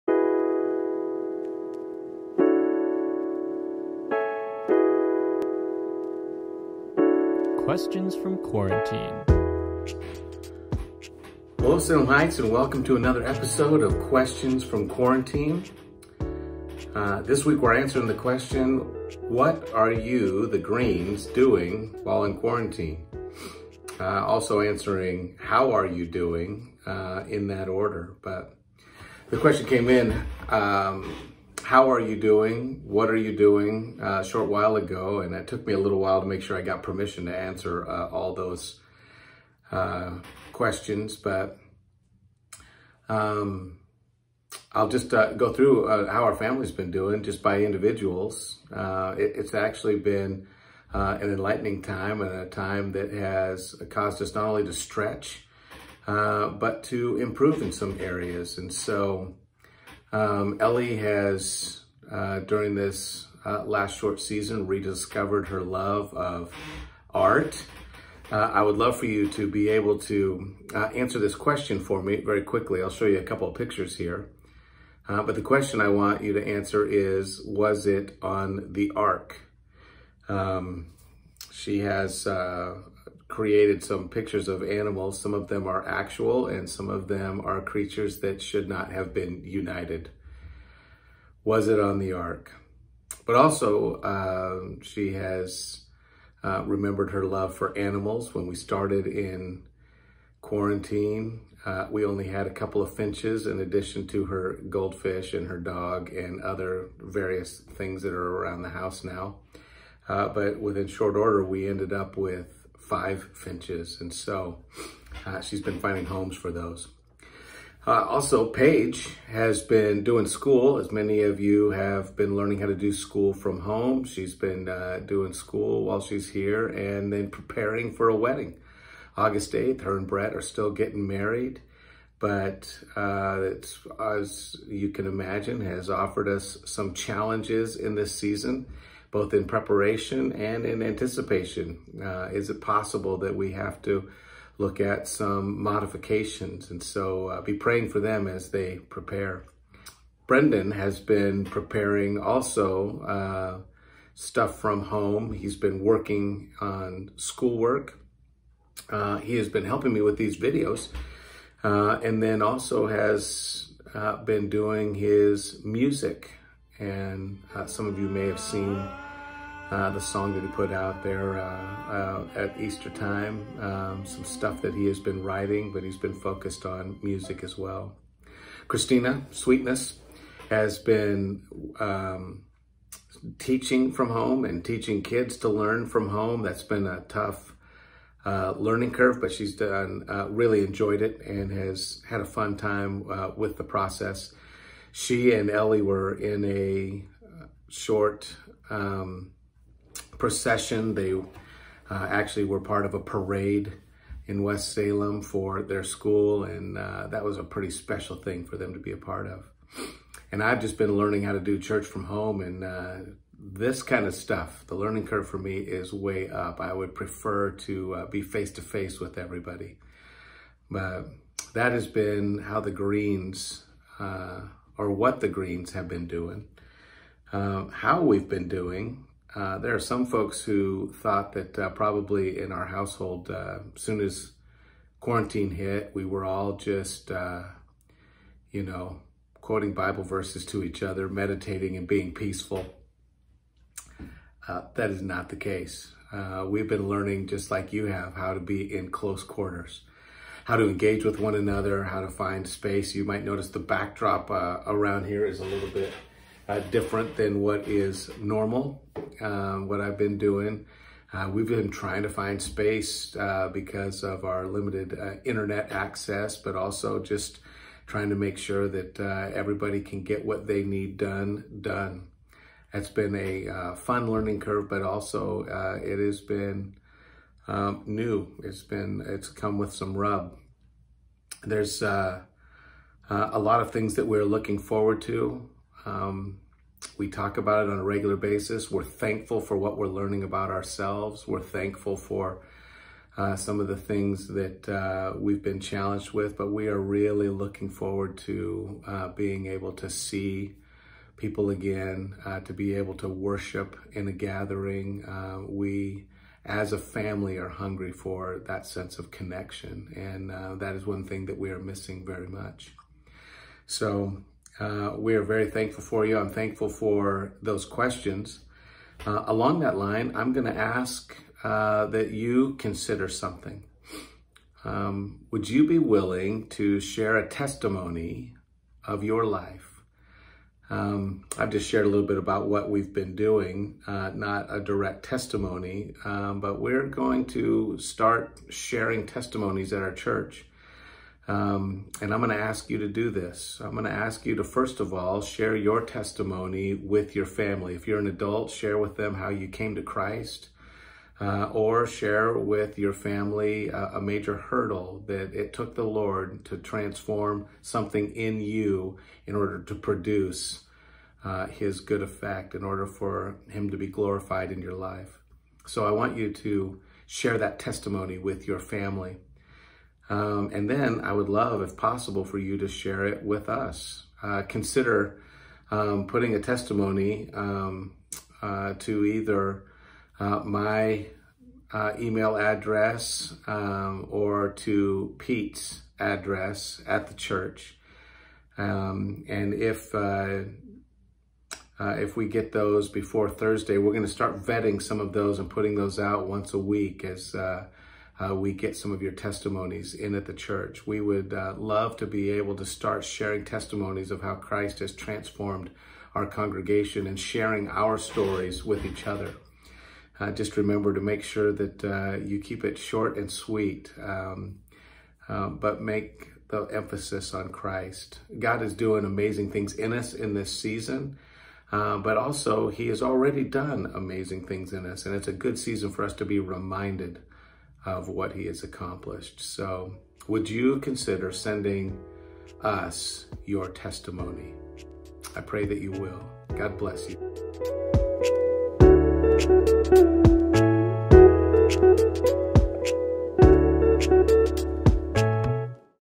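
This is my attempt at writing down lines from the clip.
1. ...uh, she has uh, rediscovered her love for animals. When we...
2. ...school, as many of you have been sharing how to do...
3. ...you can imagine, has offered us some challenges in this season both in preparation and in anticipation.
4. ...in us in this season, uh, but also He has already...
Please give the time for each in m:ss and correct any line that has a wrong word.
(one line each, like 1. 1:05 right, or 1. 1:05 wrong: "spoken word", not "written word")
1. 1:34 wrong: "remembered", not "rediscovered"
2. 2:00 wrong: "learning", not "sharing"
3. 2:14 right
4. 6:59 right.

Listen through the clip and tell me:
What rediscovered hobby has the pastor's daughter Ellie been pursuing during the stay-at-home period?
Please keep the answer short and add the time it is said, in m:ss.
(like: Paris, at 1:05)
Art, at 1:07.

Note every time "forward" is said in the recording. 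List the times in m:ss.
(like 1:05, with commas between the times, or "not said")
4:44, 4:57.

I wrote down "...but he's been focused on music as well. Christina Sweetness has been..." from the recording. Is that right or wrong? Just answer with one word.
right.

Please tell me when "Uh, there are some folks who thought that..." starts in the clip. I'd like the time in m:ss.
3:49.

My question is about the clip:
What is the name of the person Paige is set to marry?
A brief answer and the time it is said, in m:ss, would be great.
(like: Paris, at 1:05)
Brett, at 2:10.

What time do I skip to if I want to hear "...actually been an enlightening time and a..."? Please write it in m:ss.
0:49.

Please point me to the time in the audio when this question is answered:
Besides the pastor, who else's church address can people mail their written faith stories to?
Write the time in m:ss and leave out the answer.
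6:25.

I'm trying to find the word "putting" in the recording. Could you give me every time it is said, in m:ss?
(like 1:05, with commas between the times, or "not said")
6:16, 6:35.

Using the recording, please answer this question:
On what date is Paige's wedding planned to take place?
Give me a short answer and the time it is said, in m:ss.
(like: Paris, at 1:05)
August 8th, at 2:09.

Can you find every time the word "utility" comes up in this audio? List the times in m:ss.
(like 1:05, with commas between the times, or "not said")
not said.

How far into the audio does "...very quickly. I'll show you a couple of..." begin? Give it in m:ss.
1:12.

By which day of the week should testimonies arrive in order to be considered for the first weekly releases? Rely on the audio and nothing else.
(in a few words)
Thursday.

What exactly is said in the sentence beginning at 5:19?
Uh, along that line, I'm going to ask uh, that you consider something.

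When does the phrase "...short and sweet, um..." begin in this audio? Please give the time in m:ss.
6:52.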